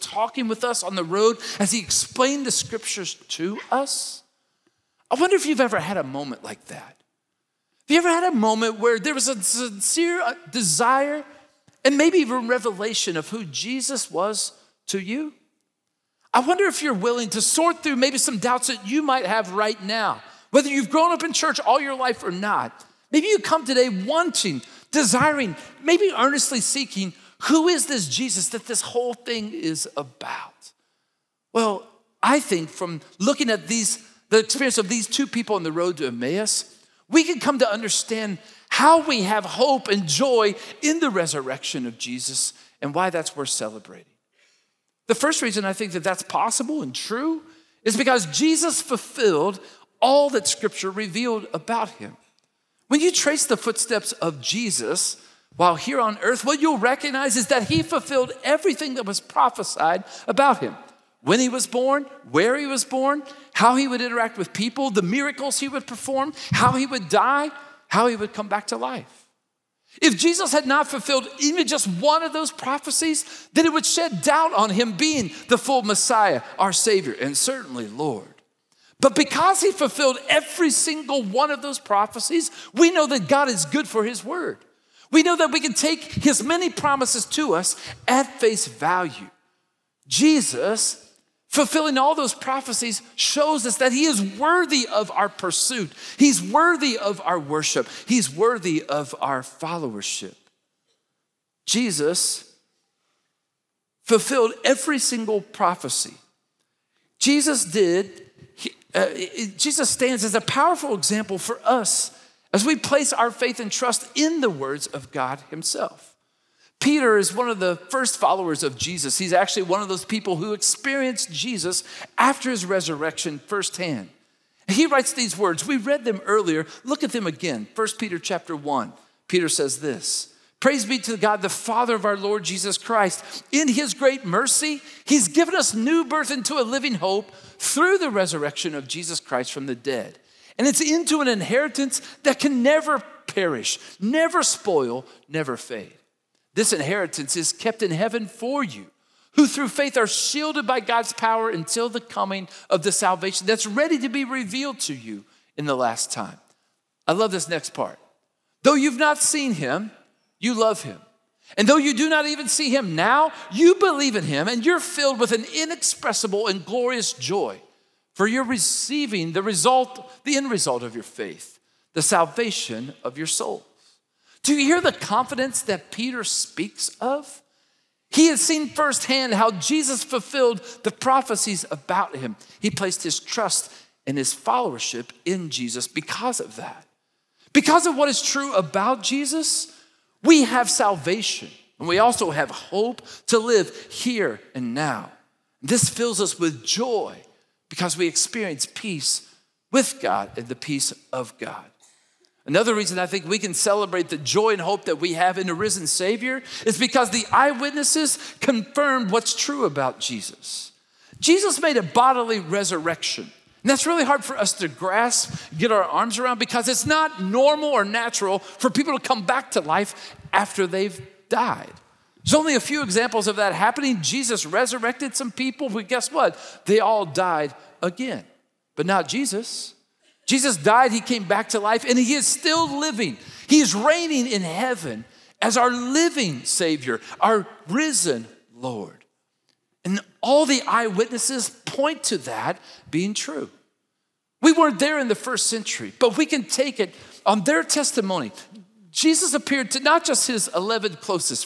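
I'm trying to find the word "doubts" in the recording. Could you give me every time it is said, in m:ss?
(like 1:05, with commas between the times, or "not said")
0:18, 1:14.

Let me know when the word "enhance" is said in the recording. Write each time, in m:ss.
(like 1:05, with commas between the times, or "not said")
not said.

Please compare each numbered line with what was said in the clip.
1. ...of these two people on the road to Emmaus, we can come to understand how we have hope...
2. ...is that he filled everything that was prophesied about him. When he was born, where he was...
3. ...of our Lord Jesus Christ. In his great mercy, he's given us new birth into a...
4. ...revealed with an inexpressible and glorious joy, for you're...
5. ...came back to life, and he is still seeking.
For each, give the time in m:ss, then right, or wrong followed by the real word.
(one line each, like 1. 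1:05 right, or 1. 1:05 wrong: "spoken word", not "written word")
1. 0:34 right
2. 0:57 wrong: "fulfilled", not "filled"
3. 2:11 right
4. 2:44 wrong: "filled", not "revealed"
5. 3:50 wrong: "living", not "seeking".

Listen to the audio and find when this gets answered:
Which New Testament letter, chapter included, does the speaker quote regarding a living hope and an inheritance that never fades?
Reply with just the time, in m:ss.
2:07.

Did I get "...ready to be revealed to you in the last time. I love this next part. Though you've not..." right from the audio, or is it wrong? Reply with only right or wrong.
right.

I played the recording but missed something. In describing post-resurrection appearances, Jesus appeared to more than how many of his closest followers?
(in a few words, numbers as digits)
11.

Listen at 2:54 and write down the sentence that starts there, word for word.
Do you hear the confidence that Peter speaks of?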